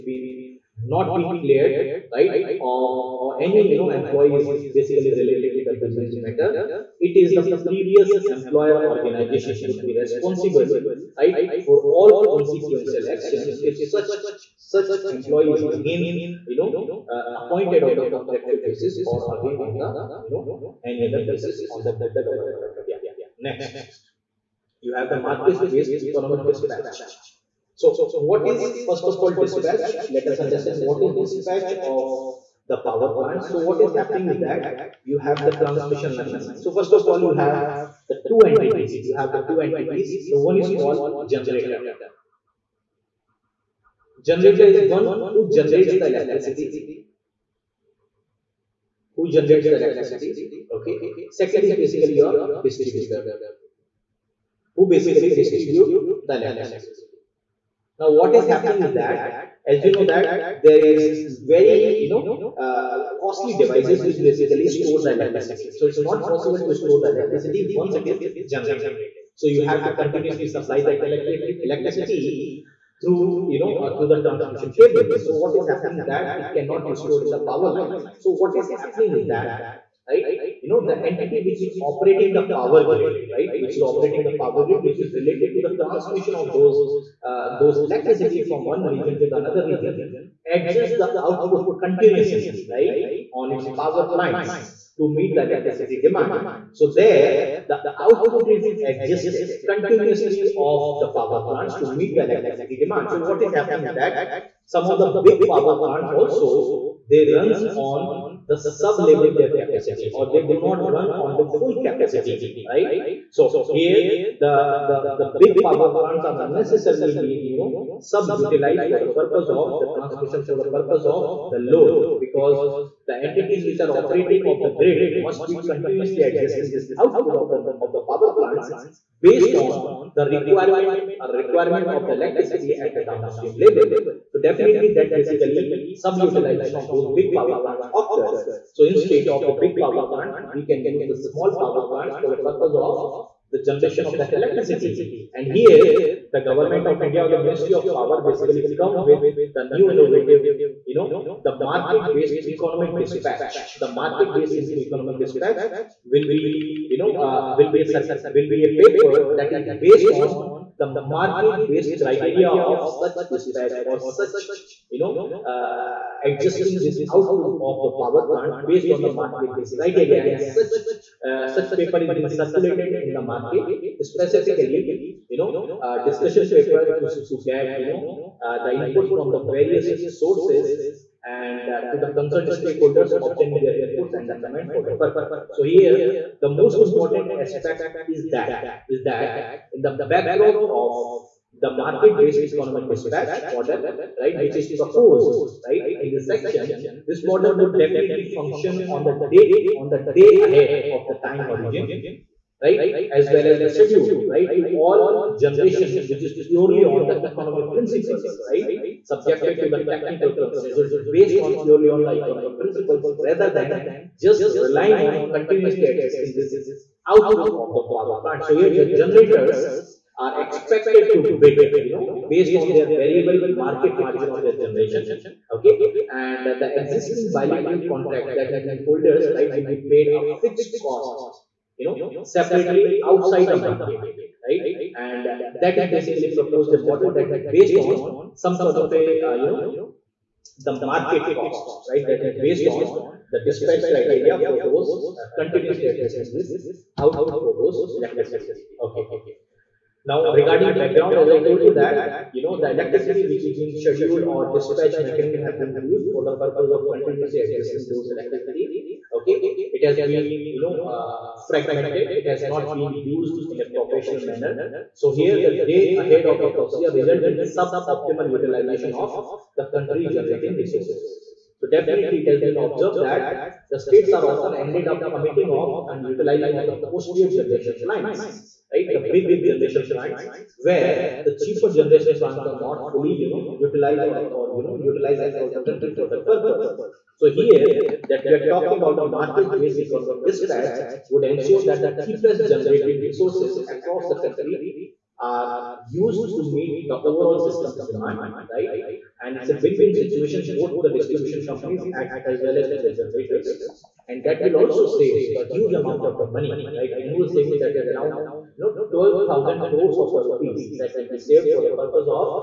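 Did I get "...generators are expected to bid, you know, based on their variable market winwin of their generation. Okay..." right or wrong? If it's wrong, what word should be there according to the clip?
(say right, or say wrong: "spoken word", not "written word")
wrong: "margin", not "winwin".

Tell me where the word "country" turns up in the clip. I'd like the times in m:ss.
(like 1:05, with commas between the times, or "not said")
4:29, 4:45, 4:54.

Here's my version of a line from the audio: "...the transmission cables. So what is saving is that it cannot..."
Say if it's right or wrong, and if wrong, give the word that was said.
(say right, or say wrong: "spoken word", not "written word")
wrong: "happening", not "saving".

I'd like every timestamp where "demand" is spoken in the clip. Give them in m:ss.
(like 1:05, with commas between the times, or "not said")
1:36, 1:42, 4:57.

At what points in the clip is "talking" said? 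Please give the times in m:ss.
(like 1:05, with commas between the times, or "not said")
4:48.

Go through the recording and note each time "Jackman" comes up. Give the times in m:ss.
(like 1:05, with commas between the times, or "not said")
not said.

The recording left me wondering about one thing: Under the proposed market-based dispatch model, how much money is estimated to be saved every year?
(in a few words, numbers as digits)
12000 crores of rupees.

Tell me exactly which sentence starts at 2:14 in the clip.
So definitely that basically sub-utilization of those big power plants occurs.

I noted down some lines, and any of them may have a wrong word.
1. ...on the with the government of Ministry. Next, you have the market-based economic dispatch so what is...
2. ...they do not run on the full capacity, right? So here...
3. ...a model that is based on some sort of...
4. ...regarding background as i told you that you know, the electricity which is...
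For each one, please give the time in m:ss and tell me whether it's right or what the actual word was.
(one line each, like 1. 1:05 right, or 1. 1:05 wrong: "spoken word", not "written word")
1. 0:21 wrong: "India", not "Ministry"
2. 1:50 right
3. 3:56 right
4. 4:10 right.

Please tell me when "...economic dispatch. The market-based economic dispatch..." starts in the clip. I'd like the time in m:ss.
2:32.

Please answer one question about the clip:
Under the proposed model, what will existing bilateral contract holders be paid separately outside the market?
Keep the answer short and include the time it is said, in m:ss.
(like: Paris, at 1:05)
Fixed cost, at 3:50.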